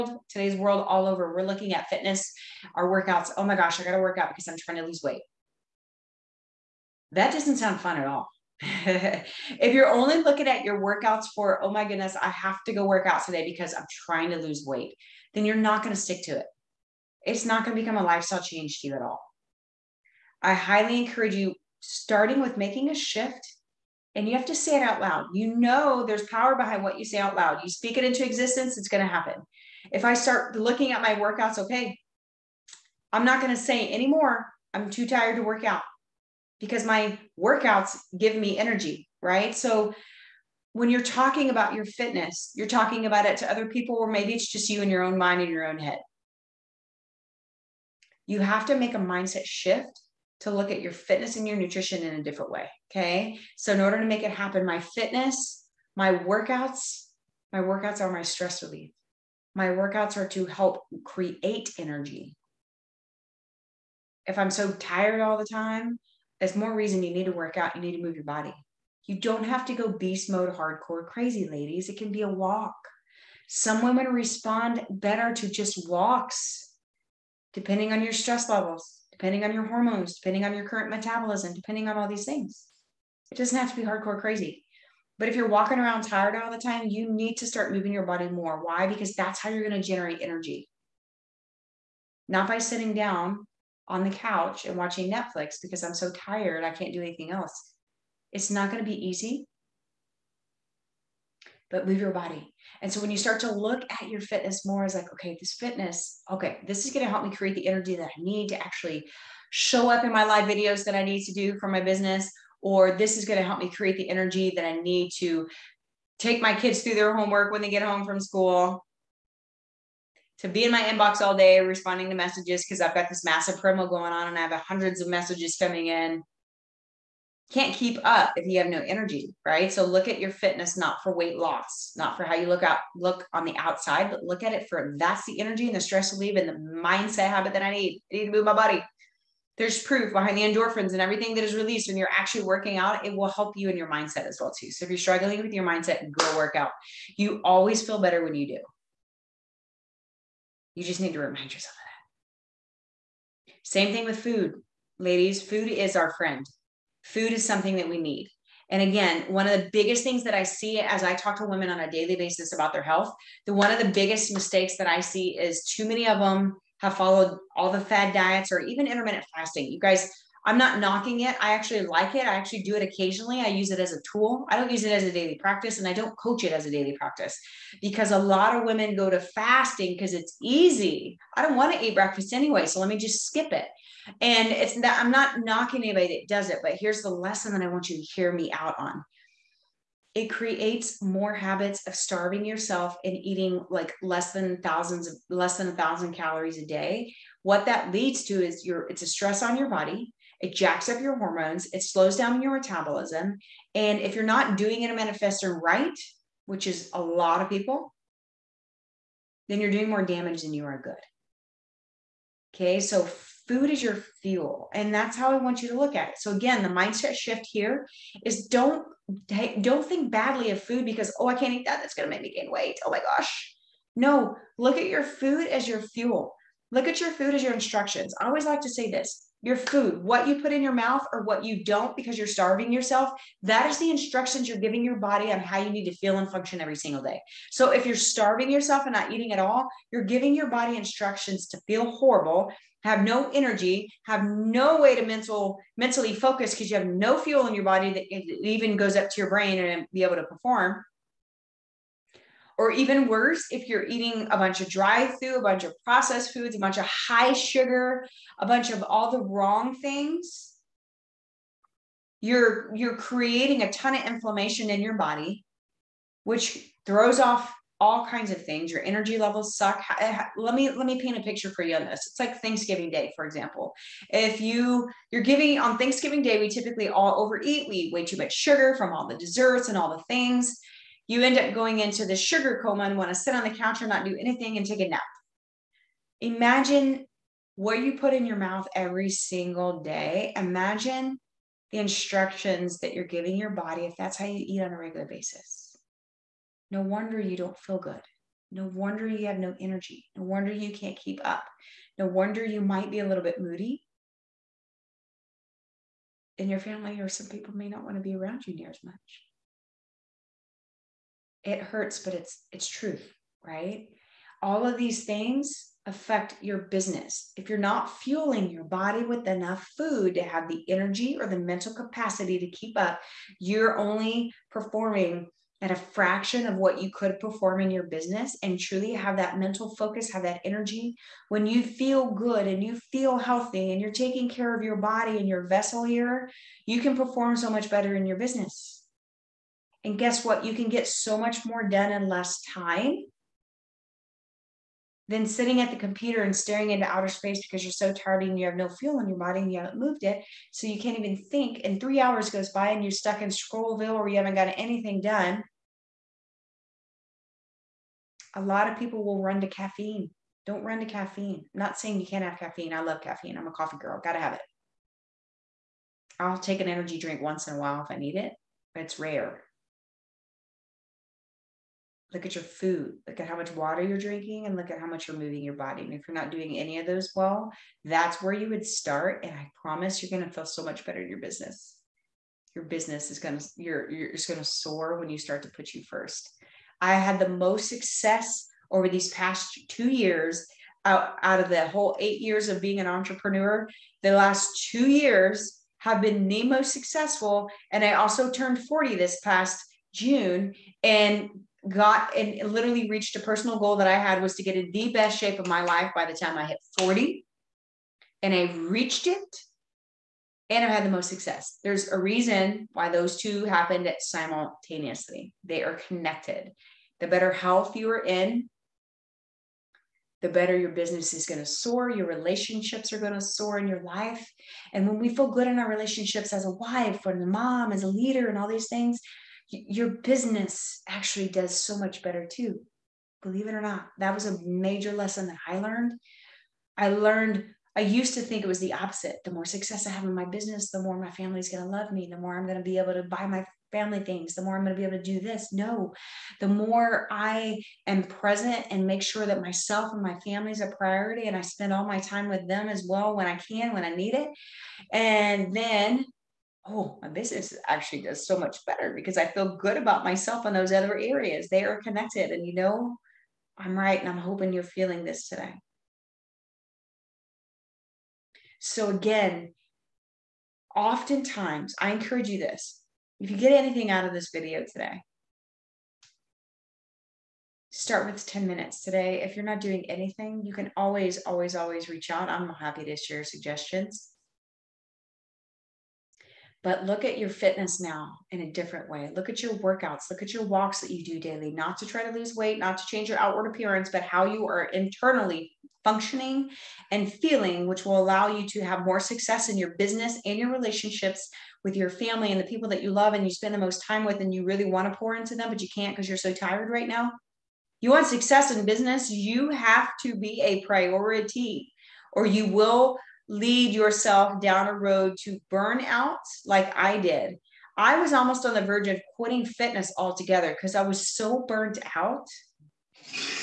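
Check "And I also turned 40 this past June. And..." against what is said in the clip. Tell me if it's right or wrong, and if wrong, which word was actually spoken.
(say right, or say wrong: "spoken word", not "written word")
right.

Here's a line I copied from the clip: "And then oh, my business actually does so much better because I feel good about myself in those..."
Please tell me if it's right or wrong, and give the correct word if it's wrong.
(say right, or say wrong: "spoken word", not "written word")
right.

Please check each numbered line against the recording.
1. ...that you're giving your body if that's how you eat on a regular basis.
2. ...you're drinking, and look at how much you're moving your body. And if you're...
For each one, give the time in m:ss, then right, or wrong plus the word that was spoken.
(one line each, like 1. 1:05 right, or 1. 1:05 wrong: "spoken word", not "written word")
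1. 4:52 right
2. 6:13 right.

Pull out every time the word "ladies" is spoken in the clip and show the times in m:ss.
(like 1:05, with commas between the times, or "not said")
1:11, 2:34.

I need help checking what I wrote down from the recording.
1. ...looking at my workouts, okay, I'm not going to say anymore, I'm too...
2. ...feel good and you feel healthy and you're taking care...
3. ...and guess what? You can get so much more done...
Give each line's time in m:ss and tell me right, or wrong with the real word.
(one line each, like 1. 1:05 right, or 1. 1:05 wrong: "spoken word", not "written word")
1. 0:30 right
2. 5:31 right
3. 5:39 right.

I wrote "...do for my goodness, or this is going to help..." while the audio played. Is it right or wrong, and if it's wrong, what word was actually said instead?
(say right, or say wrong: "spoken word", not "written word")
wrong: "business", not "goodness".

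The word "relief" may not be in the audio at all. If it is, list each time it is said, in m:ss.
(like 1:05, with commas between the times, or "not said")
0:58, 2:16.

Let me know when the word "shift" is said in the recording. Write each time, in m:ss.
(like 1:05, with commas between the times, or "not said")
0:22, 0:49, 3:37.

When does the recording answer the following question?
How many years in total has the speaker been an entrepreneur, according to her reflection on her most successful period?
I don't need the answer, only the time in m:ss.
6:31.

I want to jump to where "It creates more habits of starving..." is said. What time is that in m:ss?
3:10.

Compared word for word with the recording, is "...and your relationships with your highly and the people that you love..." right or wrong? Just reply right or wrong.
wrong.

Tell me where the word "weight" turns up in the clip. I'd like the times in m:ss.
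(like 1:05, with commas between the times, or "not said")
0:05, 0:14, 2:11, 3:42, 8:12.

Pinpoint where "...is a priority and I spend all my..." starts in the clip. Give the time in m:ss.
7:30.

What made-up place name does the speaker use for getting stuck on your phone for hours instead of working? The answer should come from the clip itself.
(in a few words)
Scrollville.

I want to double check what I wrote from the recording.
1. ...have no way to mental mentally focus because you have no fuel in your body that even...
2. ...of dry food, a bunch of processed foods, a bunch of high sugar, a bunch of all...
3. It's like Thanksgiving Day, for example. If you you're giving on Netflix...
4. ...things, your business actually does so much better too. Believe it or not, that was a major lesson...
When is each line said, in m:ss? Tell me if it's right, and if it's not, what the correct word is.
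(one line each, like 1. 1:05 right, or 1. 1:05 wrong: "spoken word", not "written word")
1. 4:04 right
2. 4:14 right
3. 4:32 wrong: "Thanksgiving", not "Netflix"
4. 7:08 right.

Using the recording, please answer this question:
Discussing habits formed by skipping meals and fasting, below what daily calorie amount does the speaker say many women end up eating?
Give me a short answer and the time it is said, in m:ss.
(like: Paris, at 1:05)
1000 calories, at 3:15.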